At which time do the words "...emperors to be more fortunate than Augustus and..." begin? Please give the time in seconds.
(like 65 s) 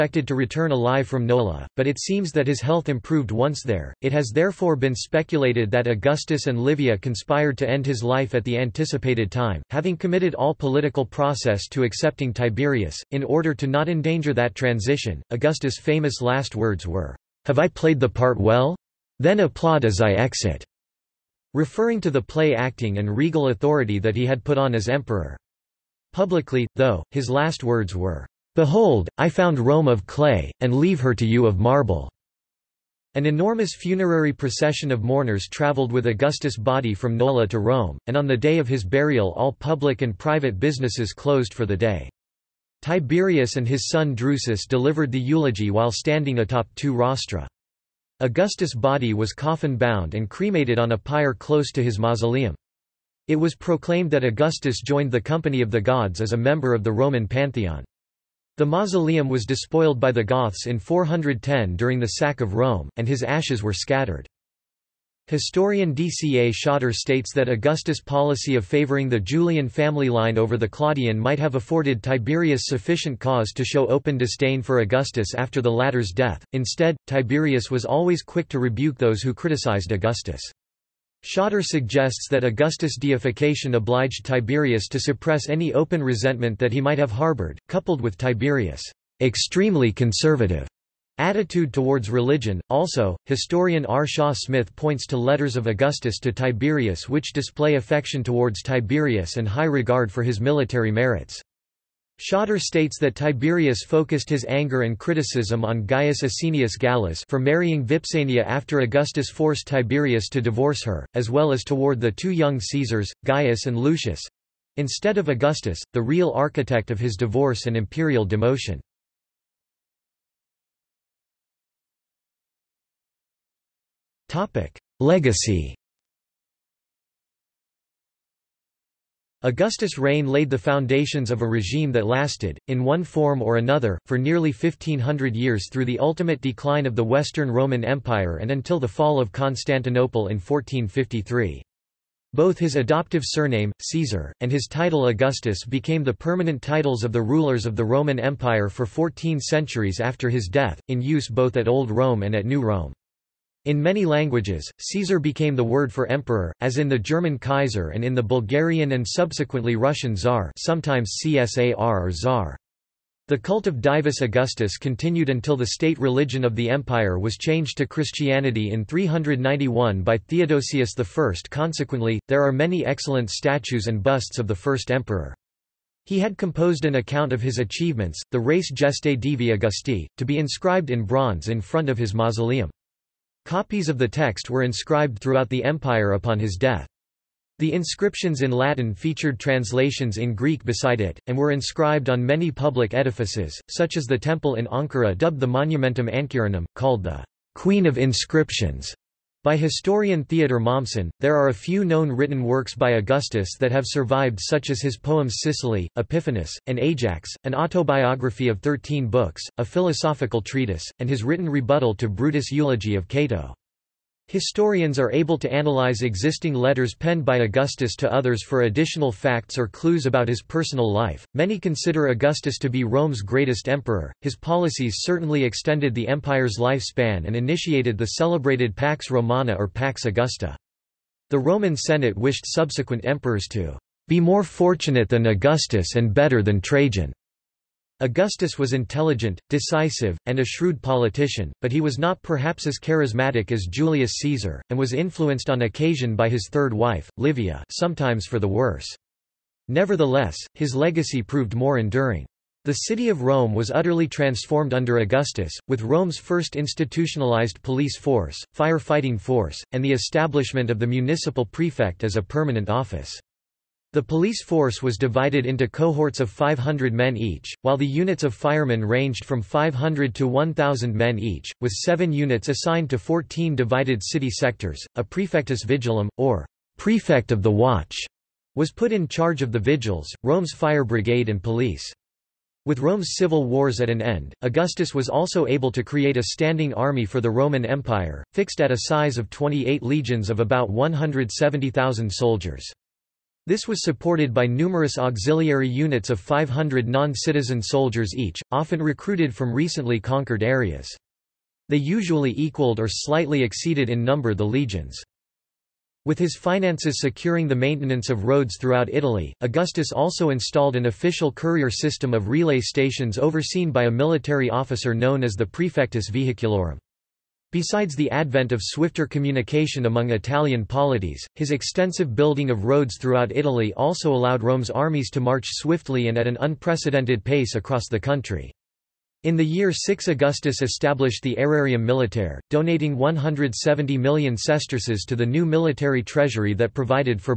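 233 s.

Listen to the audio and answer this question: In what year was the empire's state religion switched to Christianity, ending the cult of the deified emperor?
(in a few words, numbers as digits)
391.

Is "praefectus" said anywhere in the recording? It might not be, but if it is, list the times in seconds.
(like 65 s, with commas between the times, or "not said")
275 s, 315 s.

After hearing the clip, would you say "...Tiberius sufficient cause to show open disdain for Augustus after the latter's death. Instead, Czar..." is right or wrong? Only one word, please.
wrong.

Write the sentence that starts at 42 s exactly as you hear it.
Tiberius and his son Drusus delivered the eulogy while standing atop two rostra.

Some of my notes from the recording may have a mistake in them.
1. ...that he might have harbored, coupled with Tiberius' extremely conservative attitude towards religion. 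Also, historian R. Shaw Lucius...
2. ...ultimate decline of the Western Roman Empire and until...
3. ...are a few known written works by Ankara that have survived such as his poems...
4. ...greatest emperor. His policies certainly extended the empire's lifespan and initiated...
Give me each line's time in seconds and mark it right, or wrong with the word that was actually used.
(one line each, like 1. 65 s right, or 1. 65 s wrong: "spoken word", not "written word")
1. 86 s wrong: "Smith", not "Lucius"
2. 135 s right
3. 201 s wrong: "Augustus", not "Ankara"
4. 223 s right.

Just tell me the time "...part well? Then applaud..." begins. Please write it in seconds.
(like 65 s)
18 s.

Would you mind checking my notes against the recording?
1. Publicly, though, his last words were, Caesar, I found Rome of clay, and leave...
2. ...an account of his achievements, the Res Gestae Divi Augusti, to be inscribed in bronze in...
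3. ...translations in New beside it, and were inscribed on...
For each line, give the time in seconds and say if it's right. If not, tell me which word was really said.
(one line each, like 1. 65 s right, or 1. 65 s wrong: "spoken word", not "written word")
1. 26 s wrong: "Behold", not "Caesar"
2. 176 s right
3. 189 s wrong: "Greek", not "New".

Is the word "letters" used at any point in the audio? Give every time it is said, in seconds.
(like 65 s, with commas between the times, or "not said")
95 s, 216 s.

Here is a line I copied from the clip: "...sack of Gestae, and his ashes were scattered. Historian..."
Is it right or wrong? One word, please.
wrong.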